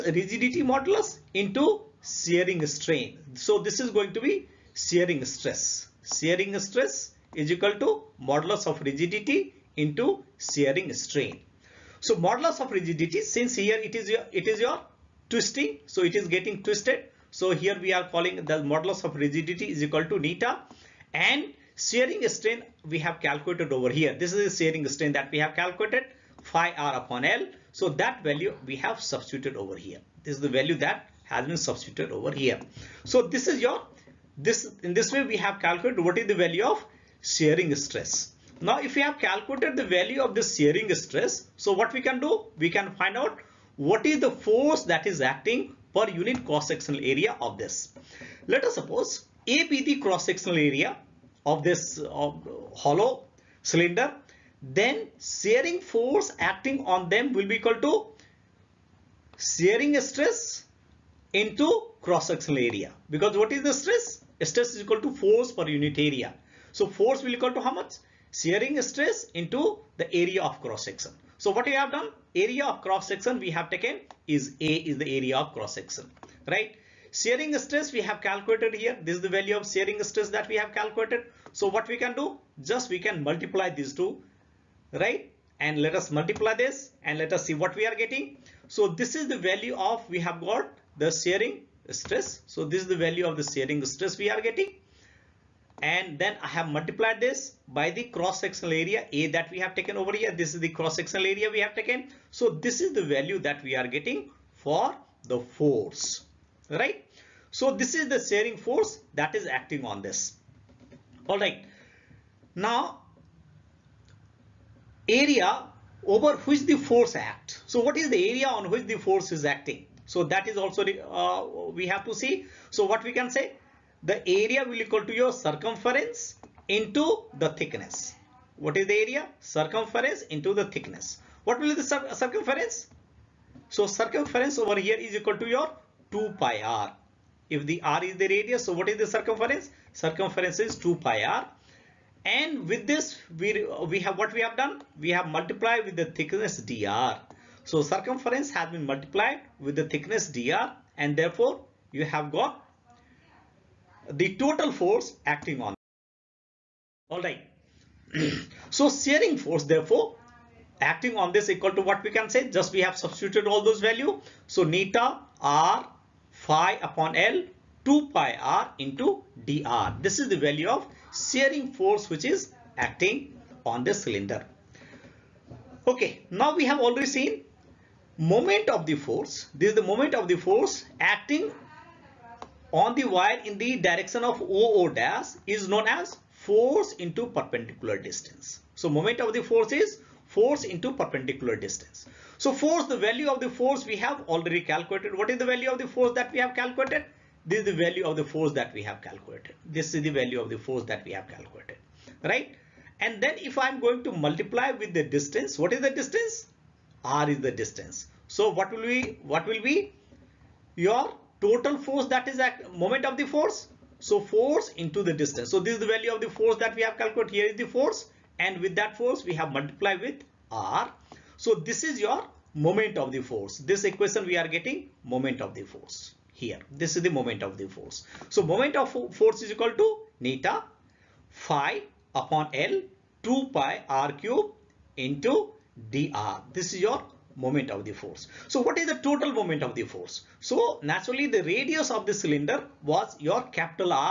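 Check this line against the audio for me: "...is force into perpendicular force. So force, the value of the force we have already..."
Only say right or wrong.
wrong.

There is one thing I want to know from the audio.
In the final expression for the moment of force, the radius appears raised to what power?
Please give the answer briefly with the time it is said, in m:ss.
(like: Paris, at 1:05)
3 (r cubed), at 3:53.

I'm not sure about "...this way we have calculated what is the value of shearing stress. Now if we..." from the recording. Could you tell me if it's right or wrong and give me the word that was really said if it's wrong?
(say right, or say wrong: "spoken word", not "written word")
right.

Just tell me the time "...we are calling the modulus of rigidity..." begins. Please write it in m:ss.
0:17.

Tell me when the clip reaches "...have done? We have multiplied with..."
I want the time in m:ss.
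2:24.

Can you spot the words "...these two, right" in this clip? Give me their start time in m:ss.
1:23.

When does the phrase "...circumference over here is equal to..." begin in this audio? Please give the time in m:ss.
2:13.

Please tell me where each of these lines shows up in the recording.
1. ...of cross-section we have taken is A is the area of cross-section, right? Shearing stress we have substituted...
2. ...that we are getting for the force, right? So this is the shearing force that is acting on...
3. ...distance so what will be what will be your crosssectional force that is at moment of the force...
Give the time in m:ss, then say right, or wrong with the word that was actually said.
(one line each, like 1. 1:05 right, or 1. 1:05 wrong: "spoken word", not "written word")
1. 1:12 wrong: "calculated", not "substituted"
2. 1:43 right
3. 3:27 wrong: "total", not "crosssectional".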